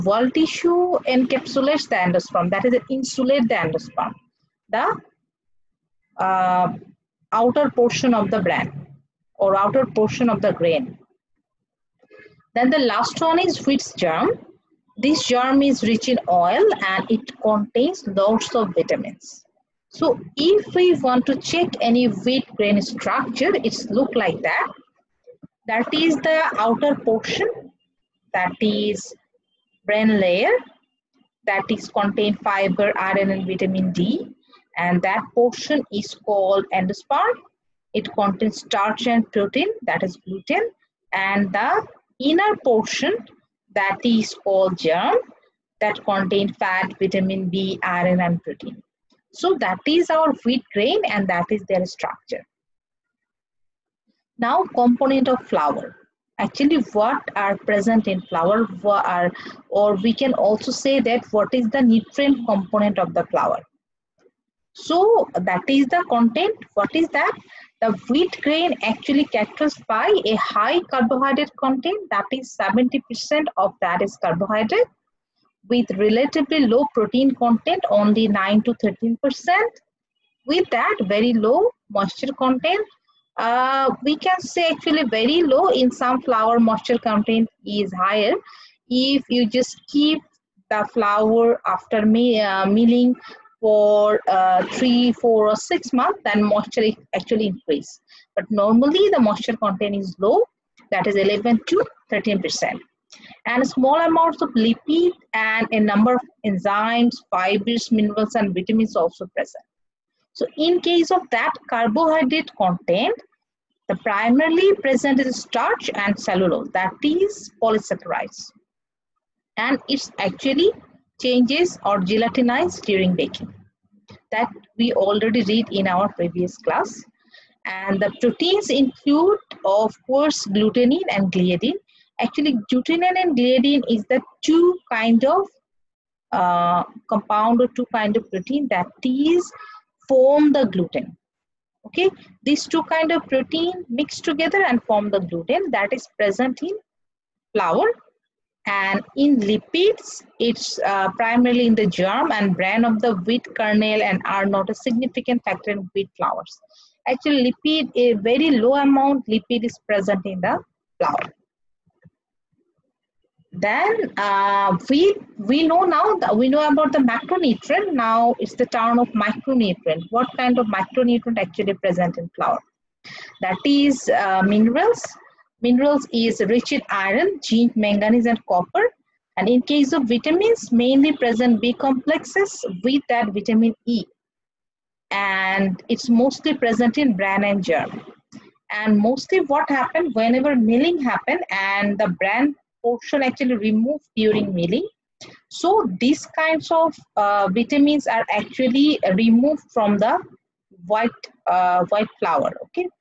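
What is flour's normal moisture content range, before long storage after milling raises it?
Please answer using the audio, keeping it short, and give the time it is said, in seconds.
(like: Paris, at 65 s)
11 to 13 percent, at 101 s.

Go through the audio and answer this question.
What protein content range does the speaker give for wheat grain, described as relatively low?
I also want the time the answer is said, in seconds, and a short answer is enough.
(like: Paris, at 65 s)
9 to 13%, at 78 s.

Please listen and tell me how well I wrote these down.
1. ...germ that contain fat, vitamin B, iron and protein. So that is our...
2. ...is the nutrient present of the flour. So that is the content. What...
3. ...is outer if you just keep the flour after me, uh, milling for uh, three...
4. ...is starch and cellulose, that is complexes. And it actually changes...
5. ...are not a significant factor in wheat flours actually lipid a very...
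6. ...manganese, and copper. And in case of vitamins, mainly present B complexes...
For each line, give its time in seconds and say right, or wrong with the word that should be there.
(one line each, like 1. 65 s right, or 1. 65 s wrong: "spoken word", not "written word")
1. 44 s right
2. 61 s wrong: "component", not "present"
3. 87 s wrong: "higher", not "outer"
4. 115 s wrong: "polysaccharides", not "complexes"
5. 154 s right
6. 177 s right.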